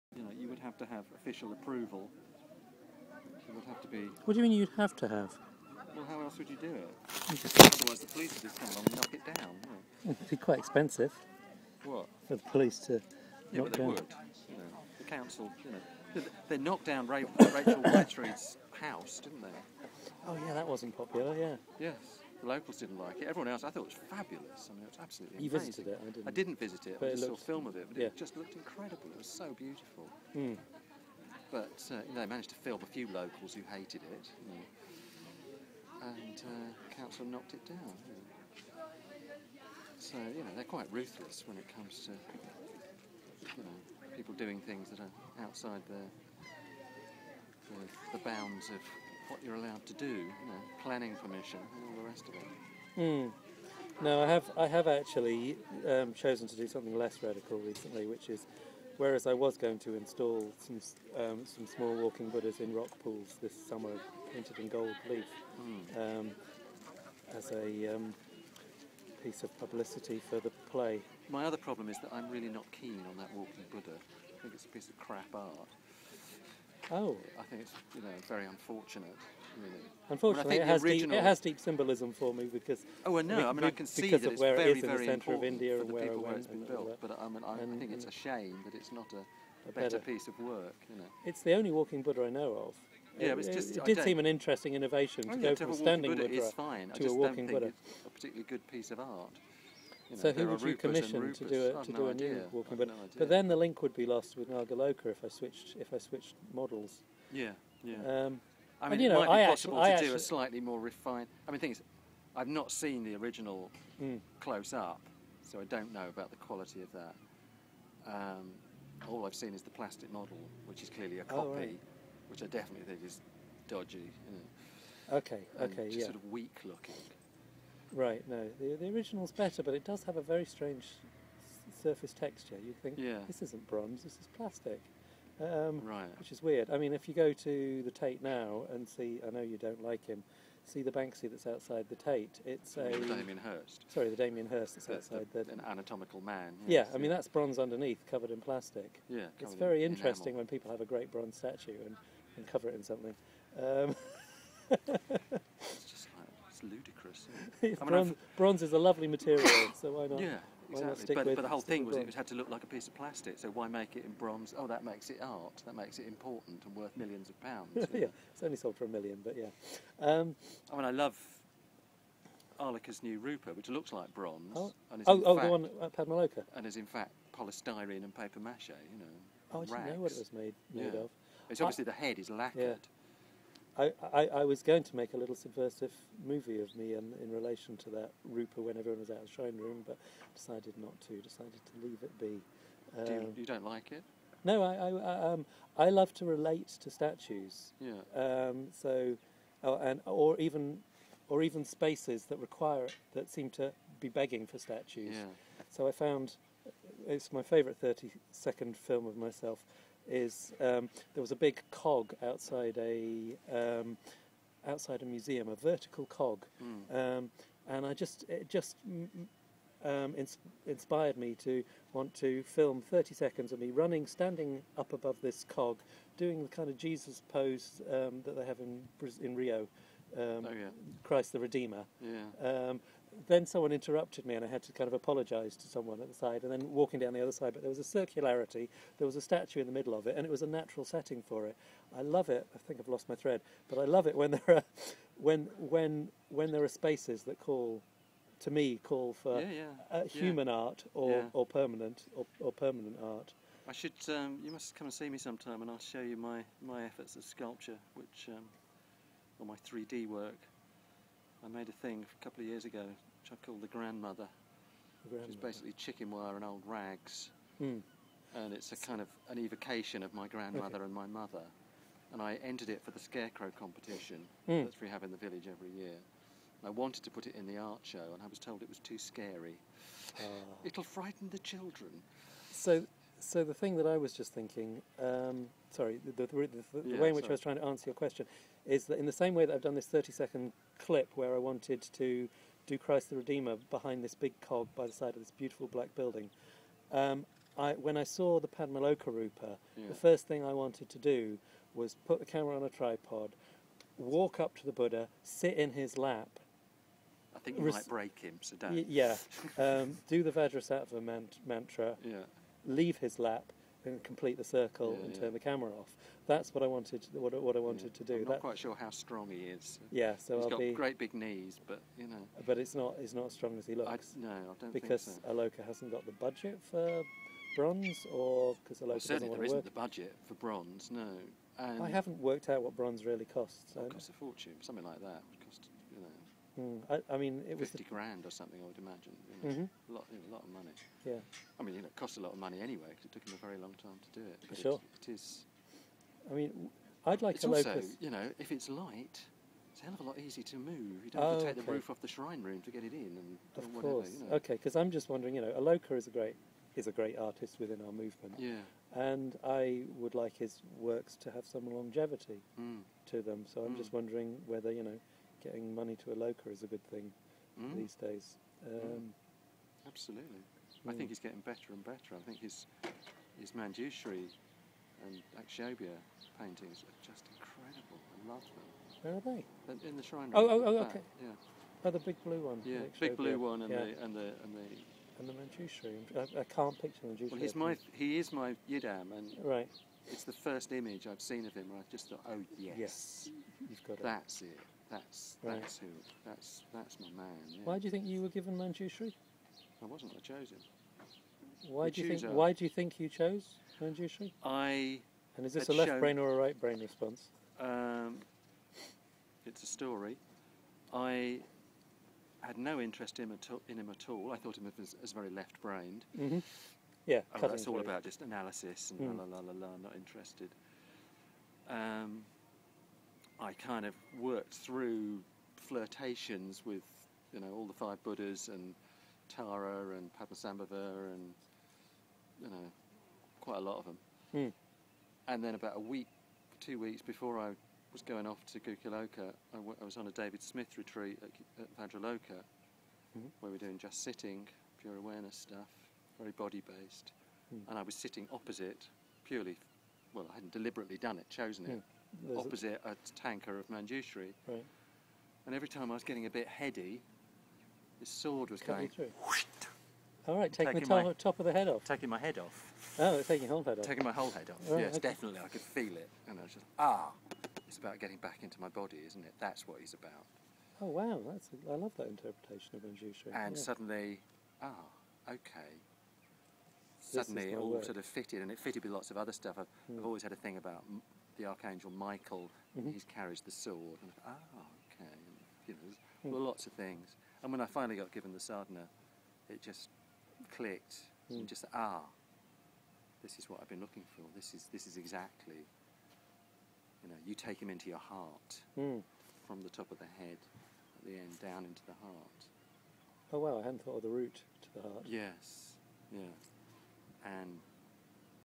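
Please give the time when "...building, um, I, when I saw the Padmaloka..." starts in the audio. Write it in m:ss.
4:55.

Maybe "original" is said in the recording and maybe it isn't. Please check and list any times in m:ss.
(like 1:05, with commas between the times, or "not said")
1:20, 1:53, 2:08.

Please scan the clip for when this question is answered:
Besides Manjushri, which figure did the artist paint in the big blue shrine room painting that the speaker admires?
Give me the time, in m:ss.
6:15.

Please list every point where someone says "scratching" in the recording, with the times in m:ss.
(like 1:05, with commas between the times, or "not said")
not said.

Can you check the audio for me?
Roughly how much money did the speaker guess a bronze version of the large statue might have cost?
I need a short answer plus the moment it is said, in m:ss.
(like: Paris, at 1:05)
50 grand, at 5:37.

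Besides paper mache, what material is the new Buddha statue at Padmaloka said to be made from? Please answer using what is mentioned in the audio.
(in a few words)
polystyrene.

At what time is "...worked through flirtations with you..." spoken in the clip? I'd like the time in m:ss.
7:04.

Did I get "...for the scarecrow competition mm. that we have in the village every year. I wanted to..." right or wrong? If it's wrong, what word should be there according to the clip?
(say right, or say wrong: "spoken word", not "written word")
right.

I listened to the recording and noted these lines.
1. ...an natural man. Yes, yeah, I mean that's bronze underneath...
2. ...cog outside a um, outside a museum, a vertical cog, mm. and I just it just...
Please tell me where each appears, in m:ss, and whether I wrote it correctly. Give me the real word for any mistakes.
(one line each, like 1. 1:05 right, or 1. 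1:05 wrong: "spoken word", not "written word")
1. 2:25 wrong: "anatomical", not "natural"
2. 3:31 right.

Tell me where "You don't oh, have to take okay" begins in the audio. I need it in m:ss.
5:51.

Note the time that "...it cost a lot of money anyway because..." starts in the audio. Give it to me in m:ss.
5:41.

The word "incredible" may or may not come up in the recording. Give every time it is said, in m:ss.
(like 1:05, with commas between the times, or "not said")
0:28, 6:17.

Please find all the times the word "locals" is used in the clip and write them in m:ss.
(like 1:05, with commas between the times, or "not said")
0:22, 0:33.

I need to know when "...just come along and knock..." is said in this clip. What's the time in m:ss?
0:08.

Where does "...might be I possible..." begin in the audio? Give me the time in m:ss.
1:49.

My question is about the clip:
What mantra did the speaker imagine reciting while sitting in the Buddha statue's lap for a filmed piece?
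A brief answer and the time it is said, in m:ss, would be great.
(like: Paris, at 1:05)
Vajrasattva mantra, at 5:10.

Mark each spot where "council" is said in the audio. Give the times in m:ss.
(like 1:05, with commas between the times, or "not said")
0:15, 0:36.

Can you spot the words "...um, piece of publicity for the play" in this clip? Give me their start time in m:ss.
1:07.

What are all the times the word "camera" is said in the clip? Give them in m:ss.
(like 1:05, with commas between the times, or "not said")
5:02, 5:15.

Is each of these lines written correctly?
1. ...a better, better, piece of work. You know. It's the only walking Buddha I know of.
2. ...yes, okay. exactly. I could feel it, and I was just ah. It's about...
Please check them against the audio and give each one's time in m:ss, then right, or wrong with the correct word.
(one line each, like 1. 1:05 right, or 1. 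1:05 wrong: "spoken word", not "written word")
1. 1:29 right
2. 7:44 wrong: "definitely", not "exactly".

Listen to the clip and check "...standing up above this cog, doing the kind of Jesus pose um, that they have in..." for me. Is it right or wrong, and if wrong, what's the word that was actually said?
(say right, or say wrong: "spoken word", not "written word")
right.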